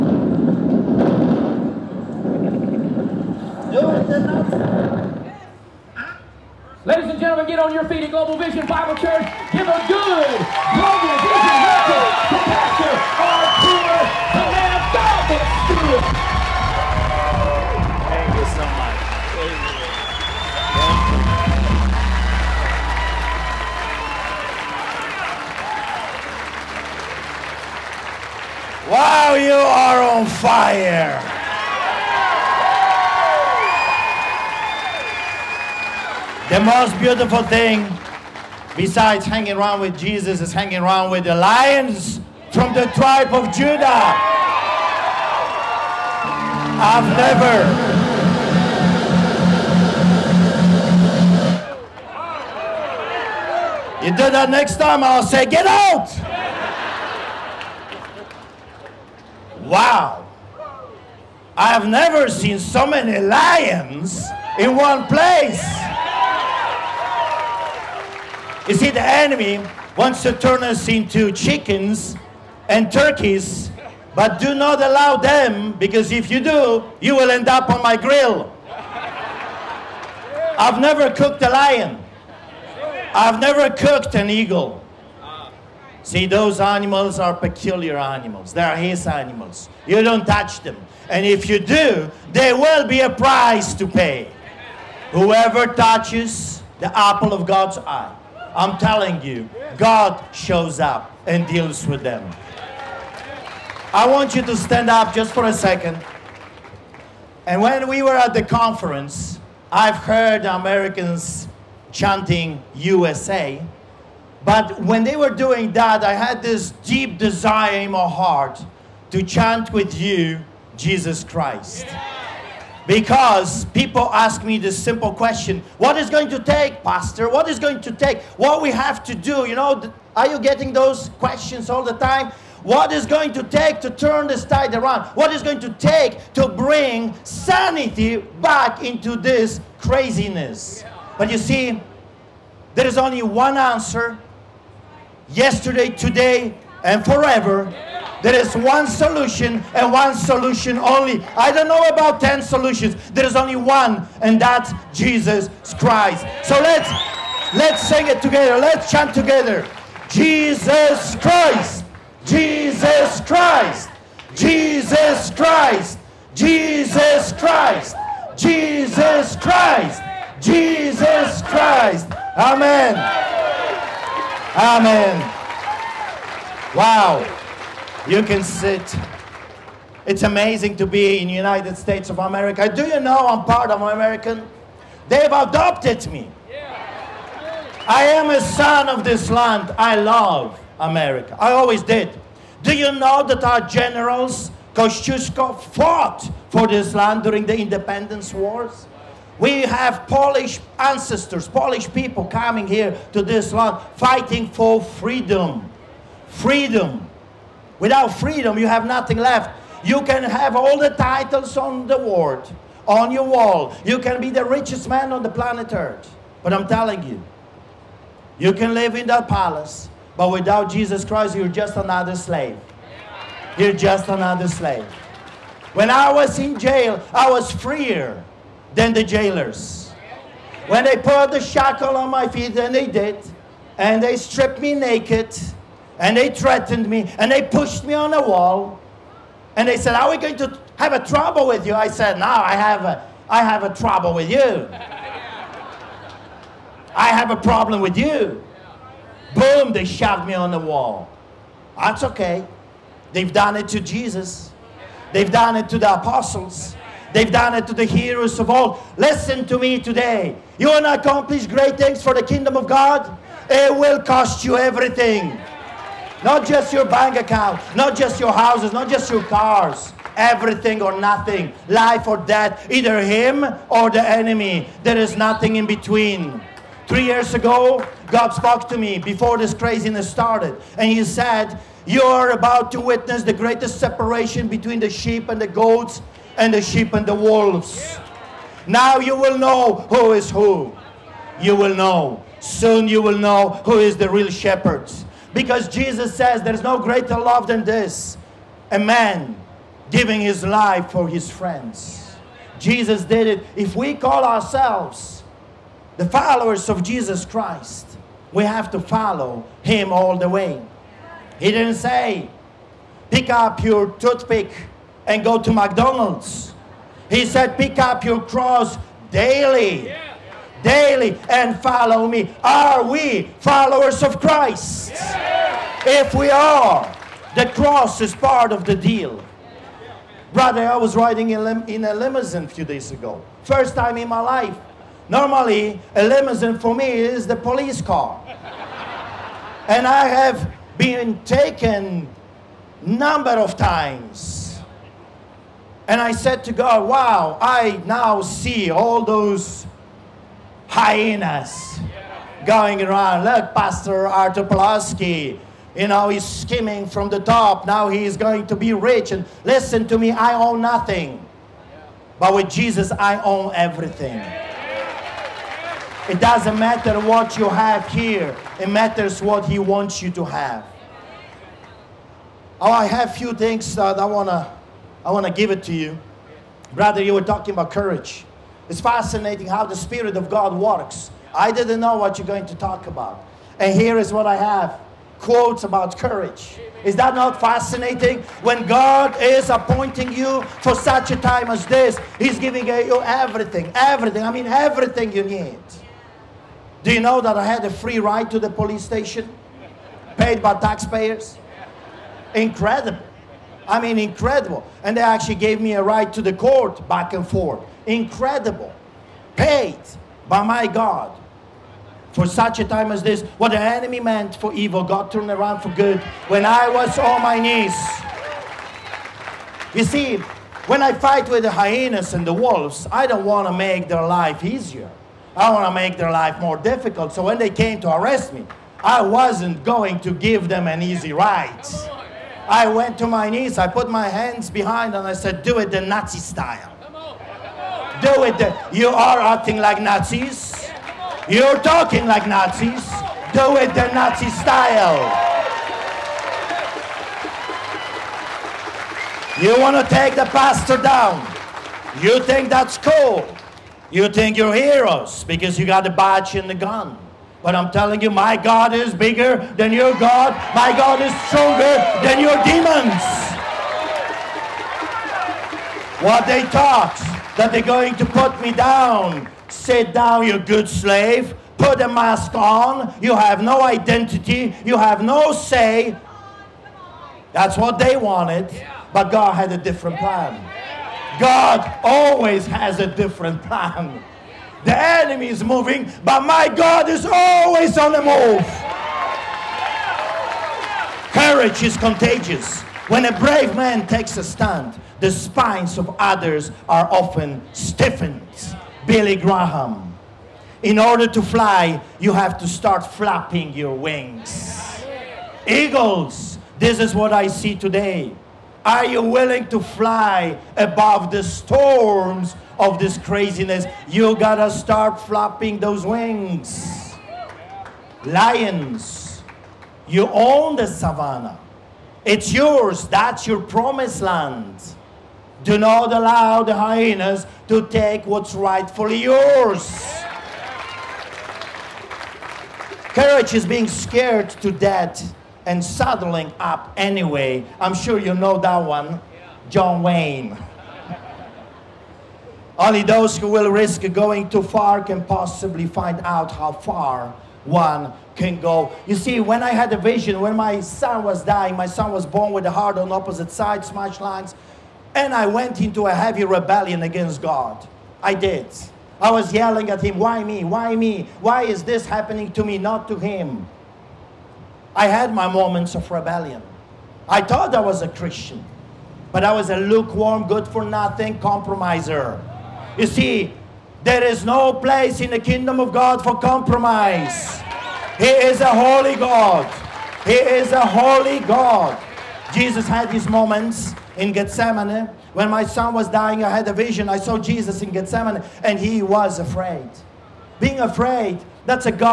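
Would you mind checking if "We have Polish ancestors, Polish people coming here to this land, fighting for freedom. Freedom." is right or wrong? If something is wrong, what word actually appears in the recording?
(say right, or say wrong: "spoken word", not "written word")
right.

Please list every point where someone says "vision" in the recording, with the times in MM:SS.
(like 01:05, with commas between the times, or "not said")
09:09, 09:46.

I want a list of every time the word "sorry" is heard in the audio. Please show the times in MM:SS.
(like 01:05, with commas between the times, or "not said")
not said.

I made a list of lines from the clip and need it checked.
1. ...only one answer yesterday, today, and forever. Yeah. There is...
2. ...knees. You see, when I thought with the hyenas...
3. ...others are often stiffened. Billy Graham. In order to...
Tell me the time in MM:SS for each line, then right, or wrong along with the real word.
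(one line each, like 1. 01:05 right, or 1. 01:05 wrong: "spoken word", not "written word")
1. 02:22 right
2. 06:57 wrong: "fight", not "thought"
3. 08:15 right.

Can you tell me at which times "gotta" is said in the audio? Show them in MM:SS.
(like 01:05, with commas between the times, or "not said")
08:34.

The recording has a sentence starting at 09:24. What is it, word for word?
I had my moments of rebellion.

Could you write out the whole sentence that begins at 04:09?
Boom, they shoved me on the wall.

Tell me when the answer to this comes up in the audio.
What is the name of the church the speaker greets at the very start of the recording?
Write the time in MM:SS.
00:08.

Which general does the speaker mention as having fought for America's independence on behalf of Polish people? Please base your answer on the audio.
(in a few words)
Kosciuszko.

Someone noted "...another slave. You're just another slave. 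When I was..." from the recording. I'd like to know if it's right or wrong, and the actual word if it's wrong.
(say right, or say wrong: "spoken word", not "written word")
right.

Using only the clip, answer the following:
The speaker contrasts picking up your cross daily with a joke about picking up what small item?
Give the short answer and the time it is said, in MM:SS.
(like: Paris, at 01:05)
toothpick, at 05:13.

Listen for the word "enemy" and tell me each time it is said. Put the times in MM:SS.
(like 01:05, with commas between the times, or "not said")
01:09, 04:34, 06:53, 08:04.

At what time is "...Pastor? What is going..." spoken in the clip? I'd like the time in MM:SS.
02:06.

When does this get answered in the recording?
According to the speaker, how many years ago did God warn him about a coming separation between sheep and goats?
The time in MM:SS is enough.
04:36.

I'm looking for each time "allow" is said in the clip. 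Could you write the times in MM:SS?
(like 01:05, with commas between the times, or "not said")
01:14, 08:45.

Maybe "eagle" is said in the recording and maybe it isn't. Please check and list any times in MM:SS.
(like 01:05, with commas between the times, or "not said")
01:24, 08:25.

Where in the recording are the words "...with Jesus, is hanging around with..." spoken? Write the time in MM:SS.
00:39.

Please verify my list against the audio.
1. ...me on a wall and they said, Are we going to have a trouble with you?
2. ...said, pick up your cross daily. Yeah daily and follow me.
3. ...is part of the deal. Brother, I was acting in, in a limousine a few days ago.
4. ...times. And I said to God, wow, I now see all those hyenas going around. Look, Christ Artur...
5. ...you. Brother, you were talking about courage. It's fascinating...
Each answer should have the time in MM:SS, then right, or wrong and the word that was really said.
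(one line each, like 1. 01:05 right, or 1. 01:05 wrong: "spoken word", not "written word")
1. 03:57 right
2. 05:17 right
3. 05:27 wrong: "riding", not "acting"
4. 05:43 wrong: "Pastor", not "Christ"
5. 06:15 right.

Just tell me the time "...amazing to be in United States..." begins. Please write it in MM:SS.
03:00.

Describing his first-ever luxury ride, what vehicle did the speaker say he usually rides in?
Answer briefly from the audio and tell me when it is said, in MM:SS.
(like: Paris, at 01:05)
the police car, at 05:37.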